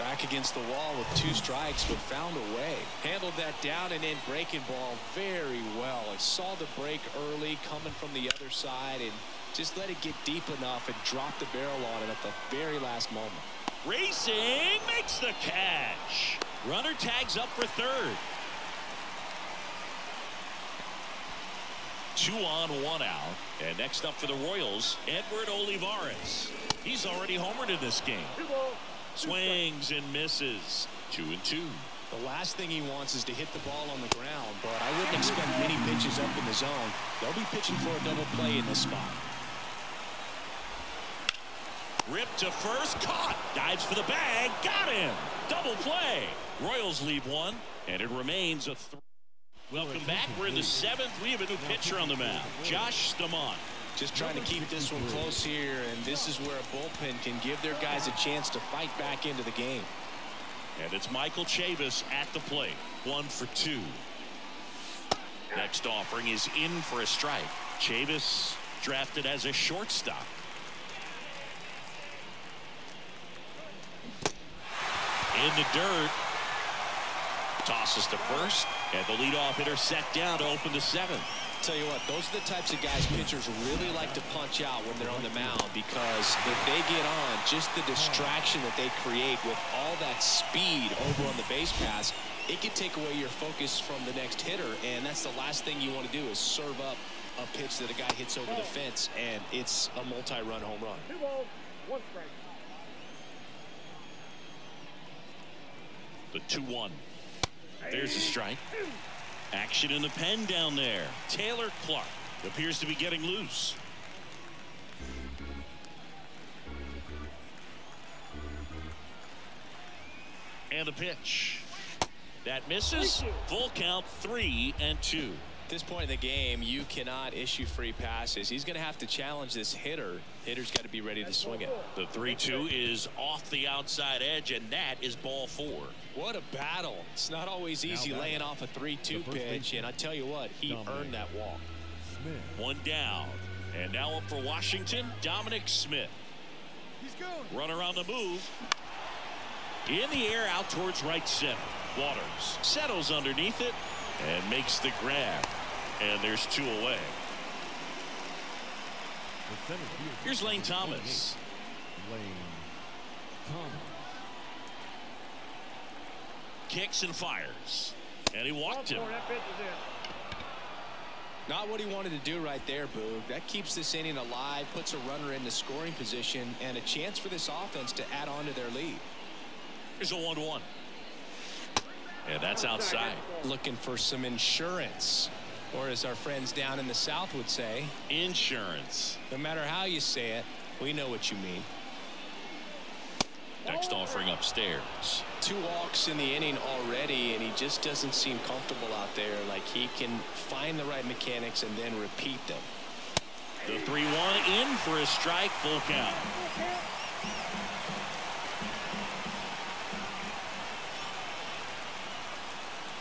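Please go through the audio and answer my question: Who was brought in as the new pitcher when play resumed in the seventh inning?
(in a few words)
Josh Staumont.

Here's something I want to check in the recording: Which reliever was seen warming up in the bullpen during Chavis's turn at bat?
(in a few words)
Taylor Clark.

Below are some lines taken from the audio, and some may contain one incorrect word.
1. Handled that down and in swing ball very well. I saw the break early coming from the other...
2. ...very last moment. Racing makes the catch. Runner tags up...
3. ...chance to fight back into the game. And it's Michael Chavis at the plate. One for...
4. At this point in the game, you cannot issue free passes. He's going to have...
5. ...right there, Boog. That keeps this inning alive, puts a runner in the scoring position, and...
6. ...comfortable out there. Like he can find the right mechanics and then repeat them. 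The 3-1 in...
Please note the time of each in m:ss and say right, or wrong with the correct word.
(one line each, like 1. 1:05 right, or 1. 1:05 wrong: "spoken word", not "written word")
1. 0:03 wrong: "breaking", not "swing"
2. 0:12 right
3. 0:58 right
4. 2:05 right
5. 2:52 right
6. 3:18 right.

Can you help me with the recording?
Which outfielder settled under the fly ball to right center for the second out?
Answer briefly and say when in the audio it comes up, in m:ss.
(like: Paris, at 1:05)
Waters, at 2:31.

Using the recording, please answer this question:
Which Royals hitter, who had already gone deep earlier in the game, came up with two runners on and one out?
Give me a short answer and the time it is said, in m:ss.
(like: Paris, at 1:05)
Edward Olivares, at 0:25.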